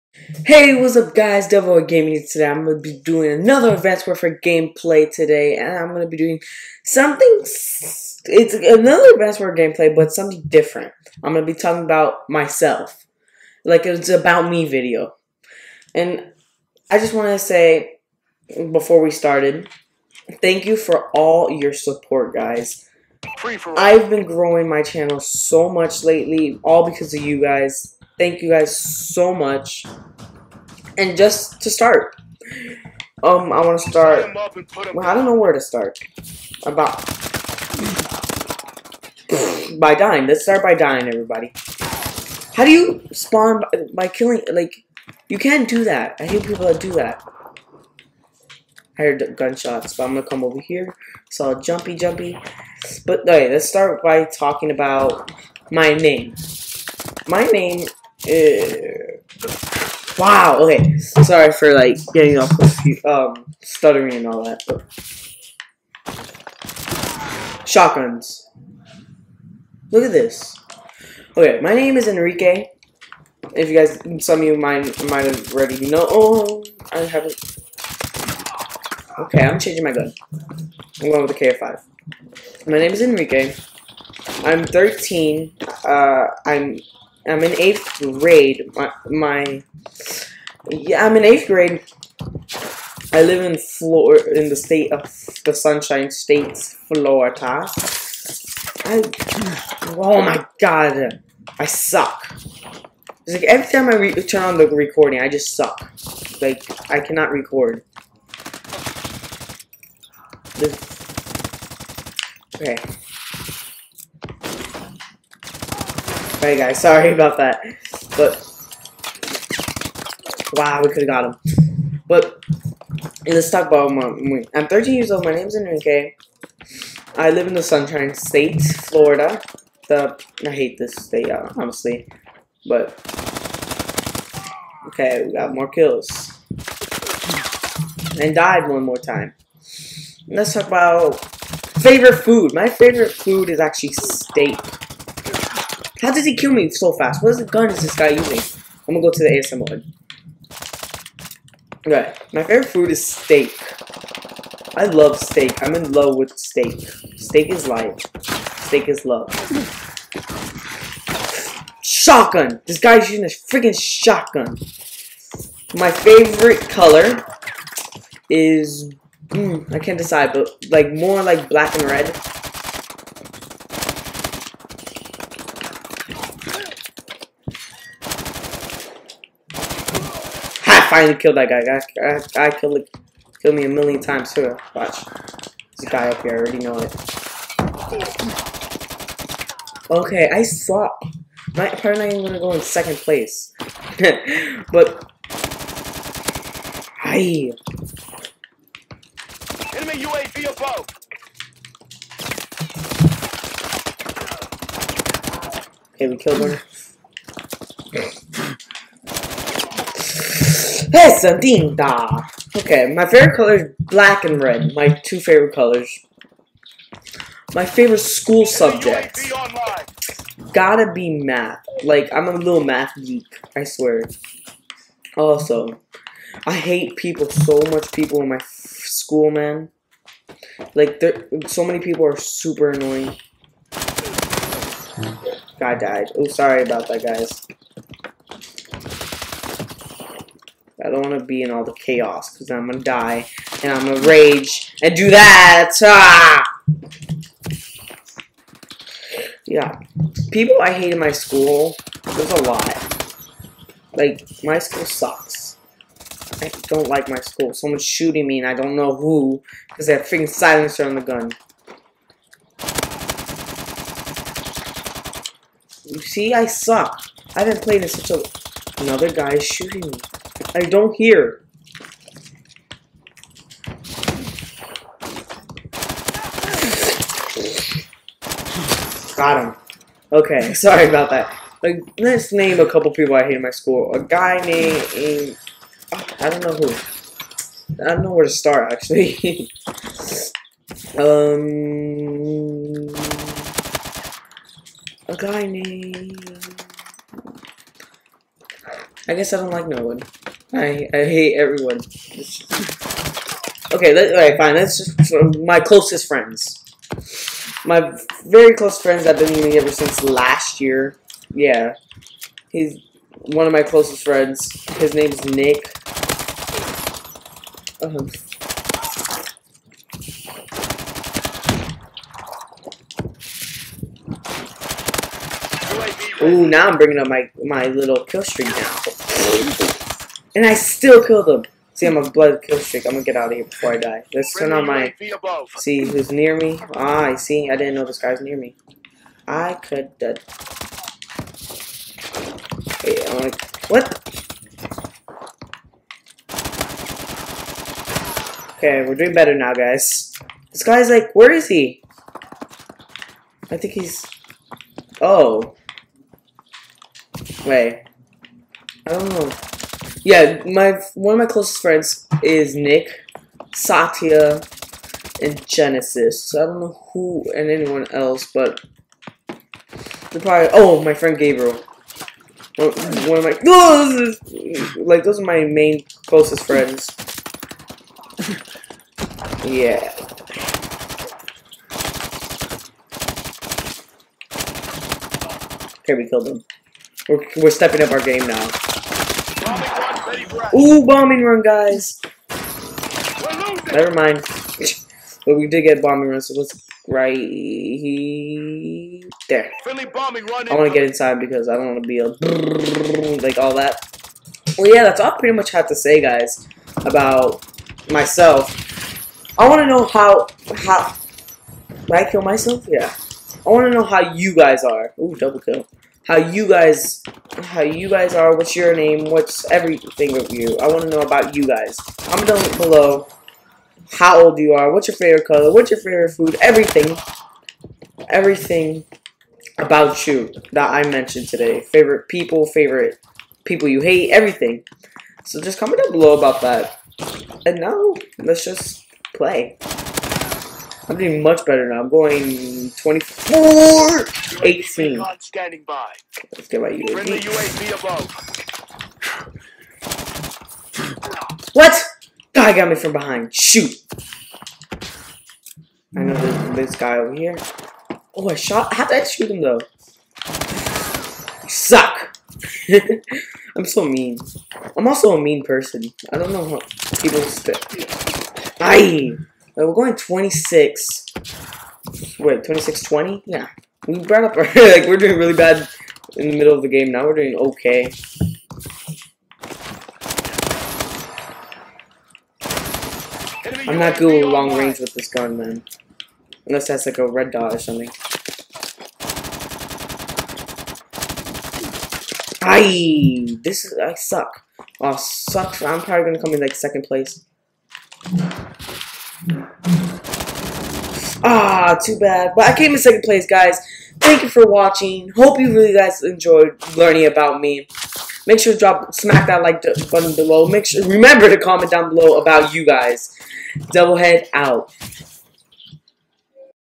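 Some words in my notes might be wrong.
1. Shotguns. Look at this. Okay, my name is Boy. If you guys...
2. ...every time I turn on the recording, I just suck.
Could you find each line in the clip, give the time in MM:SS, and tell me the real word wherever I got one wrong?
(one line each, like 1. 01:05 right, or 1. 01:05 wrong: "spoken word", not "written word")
1. 01:07 wrong: "Enrique", not "Boy"
2. 01:43 right.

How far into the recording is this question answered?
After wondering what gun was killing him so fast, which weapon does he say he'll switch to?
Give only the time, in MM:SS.
02:29.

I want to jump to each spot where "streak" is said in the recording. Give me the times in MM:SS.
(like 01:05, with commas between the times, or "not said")
05:28, 05:32.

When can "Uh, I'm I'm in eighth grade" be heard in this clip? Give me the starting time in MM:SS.
01:25.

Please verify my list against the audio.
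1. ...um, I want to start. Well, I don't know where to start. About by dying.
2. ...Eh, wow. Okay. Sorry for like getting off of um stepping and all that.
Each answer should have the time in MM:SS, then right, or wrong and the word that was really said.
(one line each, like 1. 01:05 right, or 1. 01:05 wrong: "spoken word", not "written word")
1. 00:33 right
2. 00:58 wrong: "stuttering", not "stepping".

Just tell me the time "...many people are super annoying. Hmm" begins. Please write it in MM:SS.
03:51.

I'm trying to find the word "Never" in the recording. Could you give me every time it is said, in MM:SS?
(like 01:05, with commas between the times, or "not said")
06:33.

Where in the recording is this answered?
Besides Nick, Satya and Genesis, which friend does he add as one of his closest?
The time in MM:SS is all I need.
06:11.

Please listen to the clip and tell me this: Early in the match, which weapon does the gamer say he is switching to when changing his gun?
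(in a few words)
KF5.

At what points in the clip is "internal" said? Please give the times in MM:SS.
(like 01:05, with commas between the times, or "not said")
not said.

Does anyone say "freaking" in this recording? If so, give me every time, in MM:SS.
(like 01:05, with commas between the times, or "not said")
02:43, 04:20.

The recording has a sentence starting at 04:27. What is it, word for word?
I haven't played in such a...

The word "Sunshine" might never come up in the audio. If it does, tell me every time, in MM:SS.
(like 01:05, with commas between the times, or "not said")
01:35, 02:07.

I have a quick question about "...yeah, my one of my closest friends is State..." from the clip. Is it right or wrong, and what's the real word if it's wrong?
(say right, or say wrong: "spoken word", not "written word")
wrong: "Nick", not "State".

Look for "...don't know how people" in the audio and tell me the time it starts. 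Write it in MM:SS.
07:46.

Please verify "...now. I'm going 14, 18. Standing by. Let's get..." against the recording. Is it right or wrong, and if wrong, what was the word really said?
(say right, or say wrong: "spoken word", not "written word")
wrong: "24", not "14".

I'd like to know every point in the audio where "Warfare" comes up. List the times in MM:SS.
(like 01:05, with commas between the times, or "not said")
00:04, 00:09.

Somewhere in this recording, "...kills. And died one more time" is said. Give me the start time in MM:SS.
02:15.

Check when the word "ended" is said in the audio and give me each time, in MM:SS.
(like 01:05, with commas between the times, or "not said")
not said.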